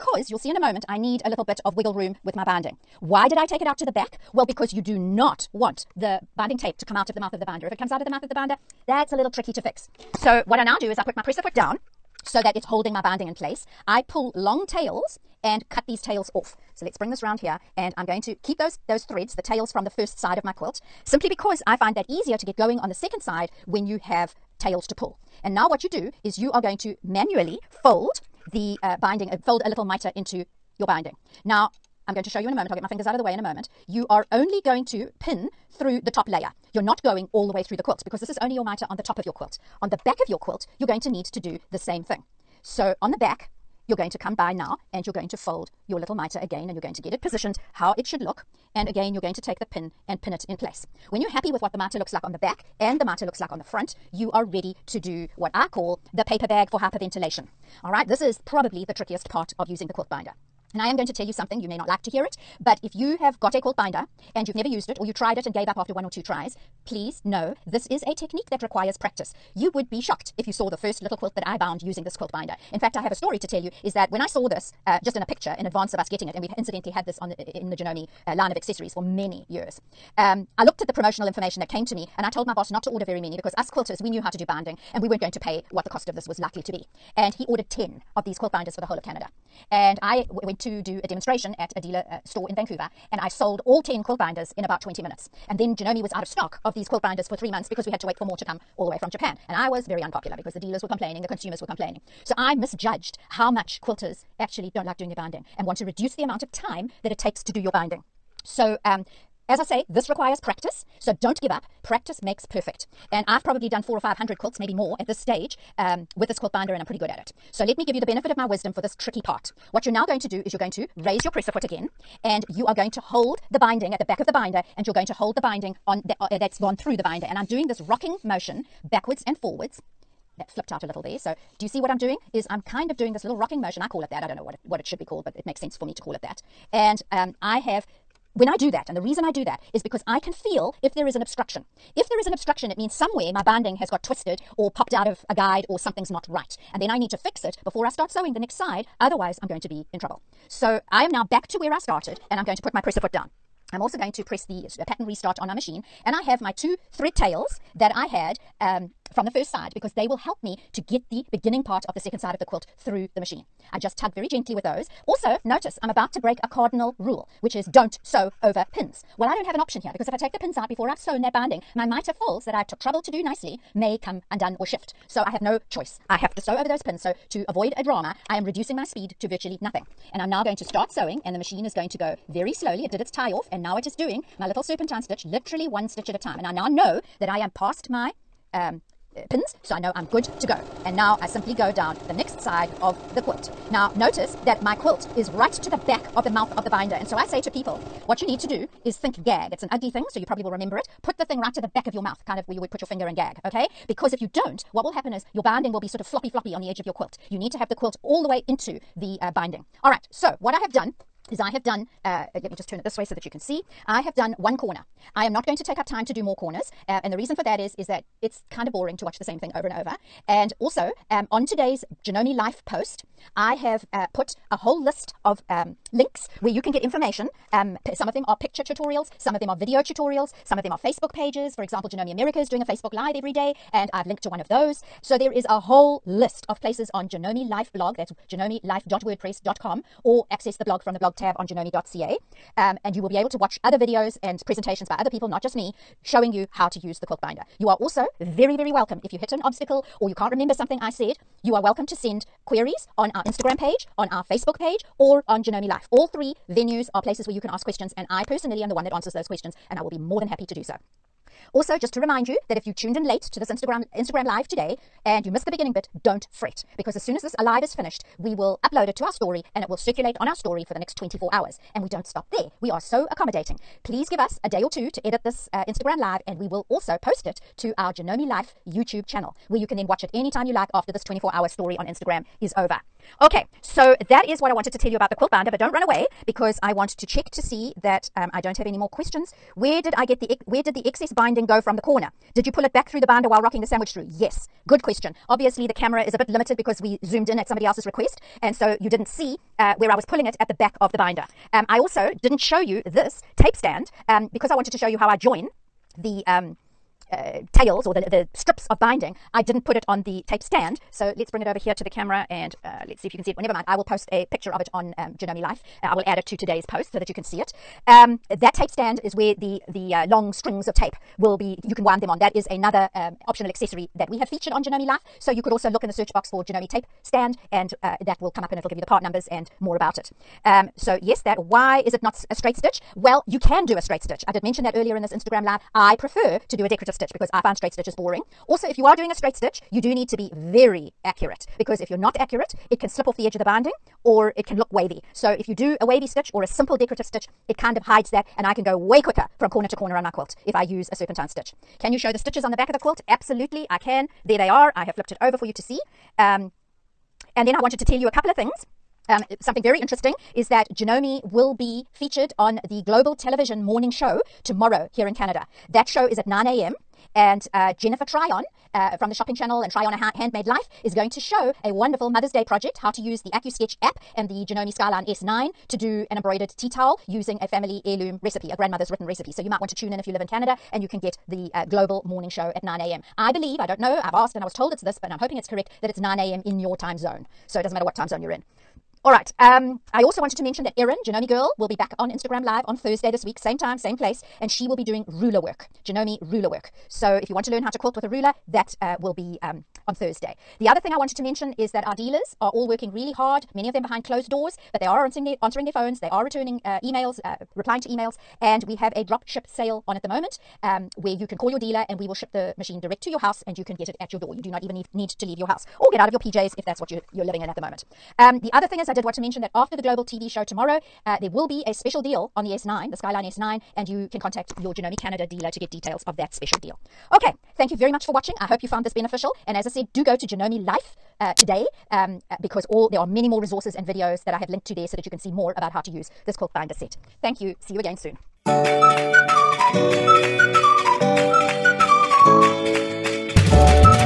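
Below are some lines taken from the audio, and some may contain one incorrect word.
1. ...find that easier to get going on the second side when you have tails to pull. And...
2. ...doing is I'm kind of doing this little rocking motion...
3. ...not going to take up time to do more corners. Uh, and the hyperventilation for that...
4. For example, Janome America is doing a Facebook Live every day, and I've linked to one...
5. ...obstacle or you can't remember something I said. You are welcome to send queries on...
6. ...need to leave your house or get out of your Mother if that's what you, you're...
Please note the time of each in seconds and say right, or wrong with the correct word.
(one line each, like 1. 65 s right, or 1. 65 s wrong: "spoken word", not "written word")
1. 21 s right
2. 131 s right
3. 215 s wrong: "reason", not "hyperventilation"
4. 231 s right
5. 249 s right
6. 414 s wrong: "PJs", not "Mother".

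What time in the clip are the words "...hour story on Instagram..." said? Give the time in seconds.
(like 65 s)
281 s.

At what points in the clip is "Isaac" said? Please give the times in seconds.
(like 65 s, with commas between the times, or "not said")
not said.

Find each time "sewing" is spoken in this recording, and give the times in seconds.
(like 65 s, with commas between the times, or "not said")
148 s, 180 s.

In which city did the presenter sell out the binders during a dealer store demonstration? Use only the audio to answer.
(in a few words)
Vancouver.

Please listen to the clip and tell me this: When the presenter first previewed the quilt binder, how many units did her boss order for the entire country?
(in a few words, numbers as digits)
10.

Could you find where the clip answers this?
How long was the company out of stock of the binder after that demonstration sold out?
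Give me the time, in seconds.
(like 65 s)
97 s.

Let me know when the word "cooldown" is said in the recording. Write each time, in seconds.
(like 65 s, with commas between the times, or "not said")
not said.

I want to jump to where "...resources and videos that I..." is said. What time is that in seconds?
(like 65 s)
433 s.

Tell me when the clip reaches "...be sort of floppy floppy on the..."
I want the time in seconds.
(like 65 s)
205 s.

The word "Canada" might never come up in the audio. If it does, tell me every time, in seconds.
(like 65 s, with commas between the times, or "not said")
89 s, 365 s, 380 s, 424 s.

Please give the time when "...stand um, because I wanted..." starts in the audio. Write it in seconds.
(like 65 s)
303 s.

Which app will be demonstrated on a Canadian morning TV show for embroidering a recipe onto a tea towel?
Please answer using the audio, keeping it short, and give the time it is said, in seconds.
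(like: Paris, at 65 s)
AccuSketch, at 373 s.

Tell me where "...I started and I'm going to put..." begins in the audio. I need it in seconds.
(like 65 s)
151 s.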